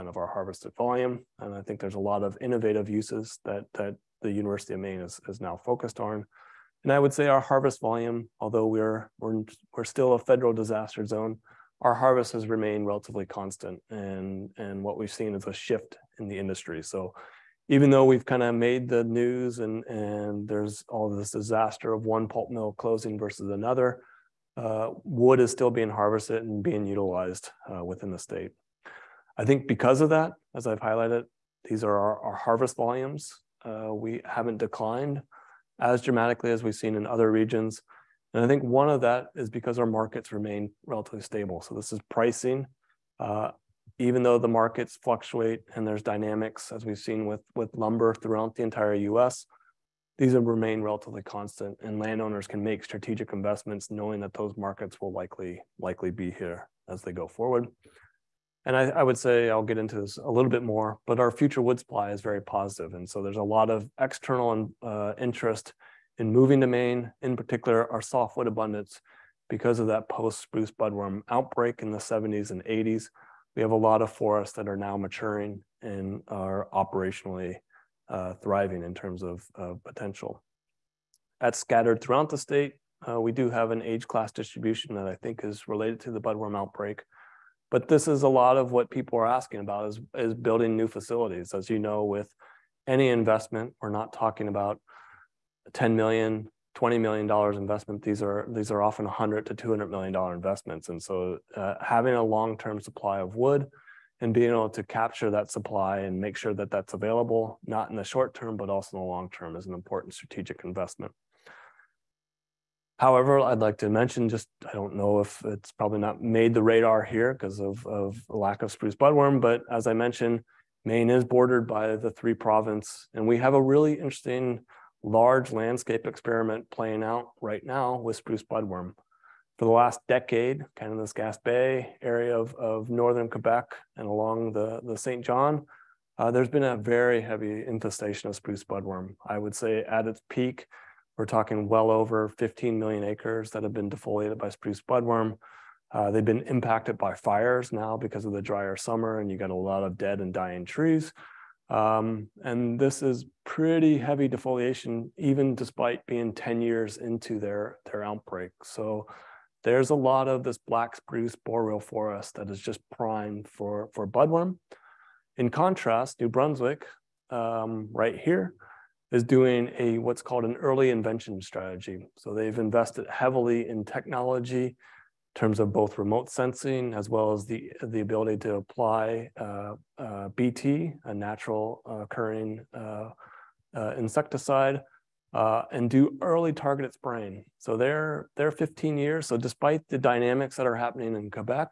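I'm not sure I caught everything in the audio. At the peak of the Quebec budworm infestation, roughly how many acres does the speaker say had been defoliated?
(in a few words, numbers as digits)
over 15 million acres.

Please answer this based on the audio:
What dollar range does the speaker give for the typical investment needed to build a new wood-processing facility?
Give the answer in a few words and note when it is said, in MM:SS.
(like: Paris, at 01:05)
100 to 200 million dollars, at 01:39.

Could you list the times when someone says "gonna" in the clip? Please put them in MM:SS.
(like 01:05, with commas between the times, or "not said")
not said.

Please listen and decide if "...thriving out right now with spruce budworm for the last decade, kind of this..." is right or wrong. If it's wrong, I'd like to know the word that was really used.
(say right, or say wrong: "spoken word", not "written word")
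wrong: "playing", not "thriving".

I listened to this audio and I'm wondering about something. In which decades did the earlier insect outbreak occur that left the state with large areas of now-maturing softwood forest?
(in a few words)
70s and 80s.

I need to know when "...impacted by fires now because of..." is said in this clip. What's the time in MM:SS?
02:26.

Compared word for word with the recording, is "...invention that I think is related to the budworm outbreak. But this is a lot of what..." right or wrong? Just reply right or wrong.
wrong.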